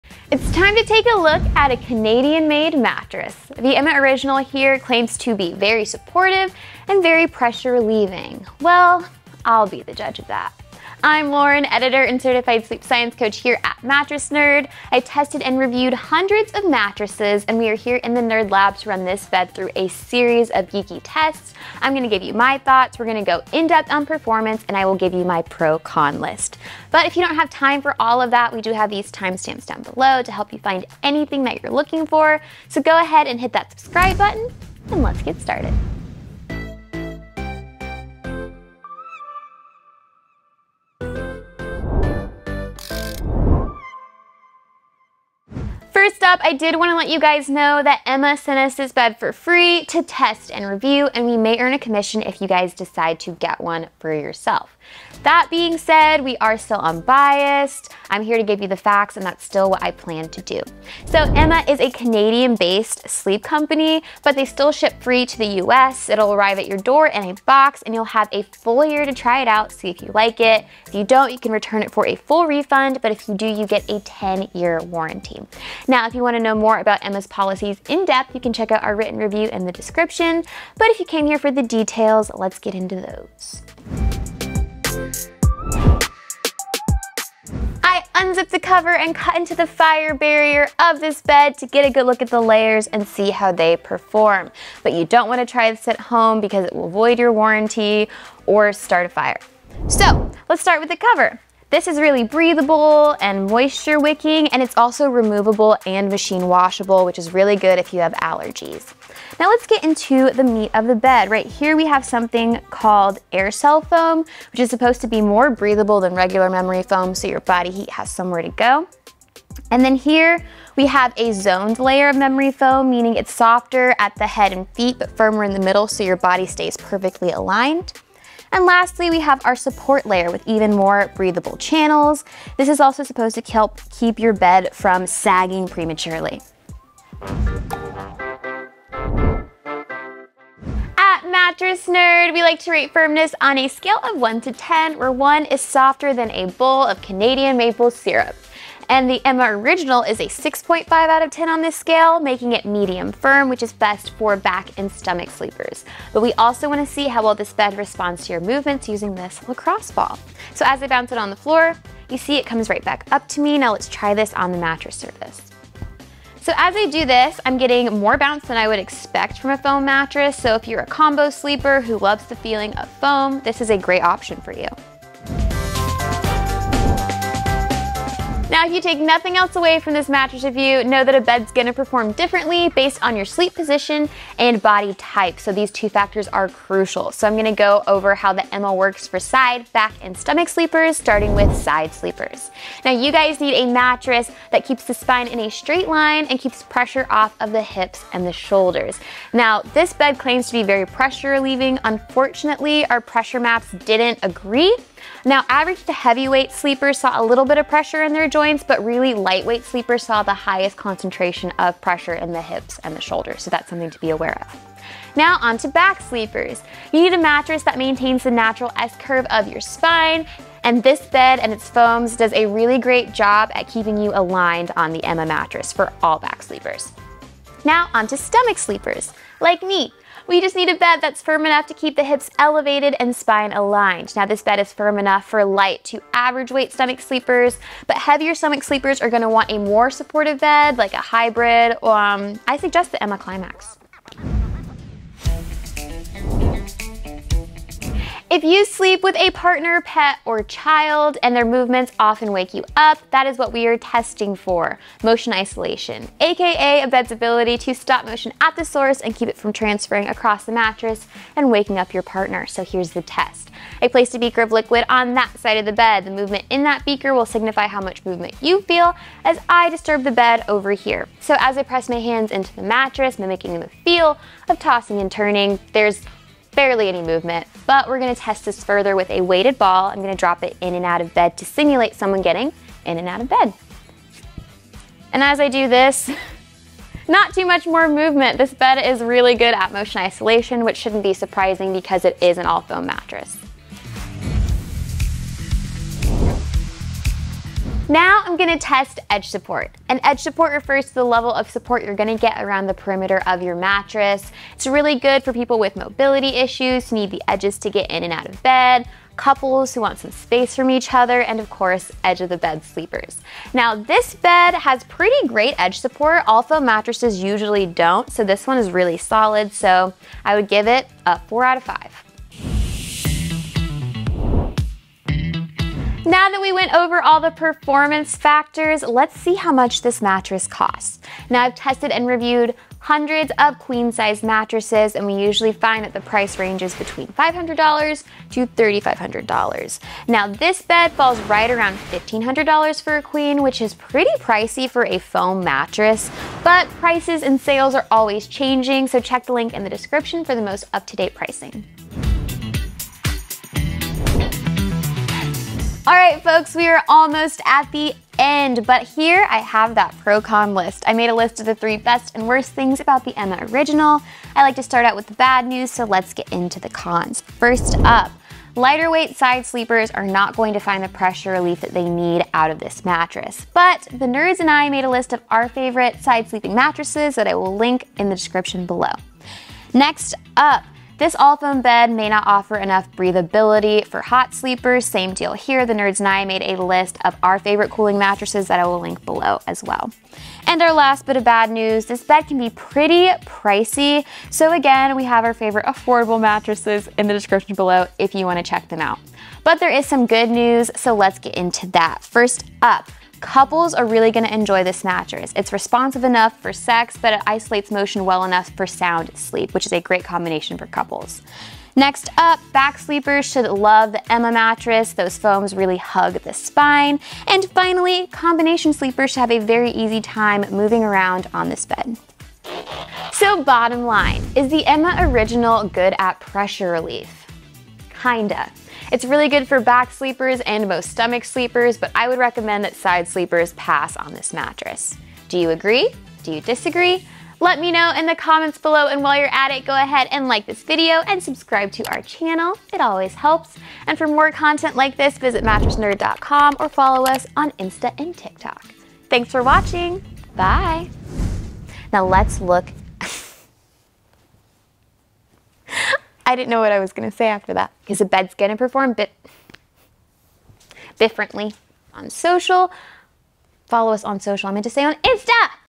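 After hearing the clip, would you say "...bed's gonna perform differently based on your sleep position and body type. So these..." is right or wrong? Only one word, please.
right.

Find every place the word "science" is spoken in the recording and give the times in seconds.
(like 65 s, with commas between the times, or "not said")
12 s.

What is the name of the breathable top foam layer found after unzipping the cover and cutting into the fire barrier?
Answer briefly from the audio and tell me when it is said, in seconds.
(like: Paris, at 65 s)
air cell foam, at 113 s.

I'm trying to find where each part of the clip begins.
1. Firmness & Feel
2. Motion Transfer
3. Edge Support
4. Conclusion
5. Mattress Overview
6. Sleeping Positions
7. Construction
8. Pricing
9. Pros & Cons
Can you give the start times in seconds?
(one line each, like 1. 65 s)
1. 138 s
2. 245 s
3. 295 s
4. 422 s
5. 44 s
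6. 176 s
7. 85 s
8. 323 s
9. 352 s.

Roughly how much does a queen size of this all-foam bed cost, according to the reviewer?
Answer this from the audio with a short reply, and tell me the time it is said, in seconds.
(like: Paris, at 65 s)
$1,500, at 341 s.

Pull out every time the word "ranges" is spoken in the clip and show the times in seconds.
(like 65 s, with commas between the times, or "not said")
336 s.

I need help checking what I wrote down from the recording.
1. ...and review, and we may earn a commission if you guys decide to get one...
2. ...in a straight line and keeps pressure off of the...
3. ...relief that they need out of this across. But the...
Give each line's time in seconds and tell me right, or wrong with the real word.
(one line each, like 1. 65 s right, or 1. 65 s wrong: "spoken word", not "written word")
1. 50 s right
2. 195 s right
3. 371 s wrong: "mattress", not "across".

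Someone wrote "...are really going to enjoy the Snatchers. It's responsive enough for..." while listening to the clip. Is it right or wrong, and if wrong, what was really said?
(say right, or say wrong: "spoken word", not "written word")
right.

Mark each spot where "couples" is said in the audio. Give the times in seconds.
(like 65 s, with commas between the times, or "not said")
309 s, 403 s, 410 s.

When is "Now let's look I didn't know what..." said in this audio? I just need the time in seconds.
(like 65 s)
451 s.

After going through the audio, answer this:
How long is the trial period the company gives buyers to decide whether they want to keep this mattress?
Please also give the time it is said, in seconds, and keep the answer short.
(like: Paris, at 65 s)
a full year, at 68 s.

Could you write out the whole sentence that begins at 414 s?
Those foams really hug the spine.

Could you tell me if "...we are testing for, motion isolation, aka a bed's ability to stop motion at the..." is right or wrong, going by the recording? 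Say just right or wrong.
right.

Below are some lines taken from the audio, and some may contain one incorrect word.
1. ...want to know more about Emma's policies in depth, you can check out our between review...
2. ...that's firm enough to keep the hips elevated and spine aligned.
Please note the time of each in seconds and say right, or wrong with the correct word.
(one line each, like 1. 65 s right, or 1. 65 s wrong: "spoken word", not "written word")
1. 76 s wrong: "written", not "between"
2. 231 s right.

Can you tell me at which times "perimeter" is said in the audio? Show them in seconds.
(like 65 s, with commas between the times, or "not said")
302 s.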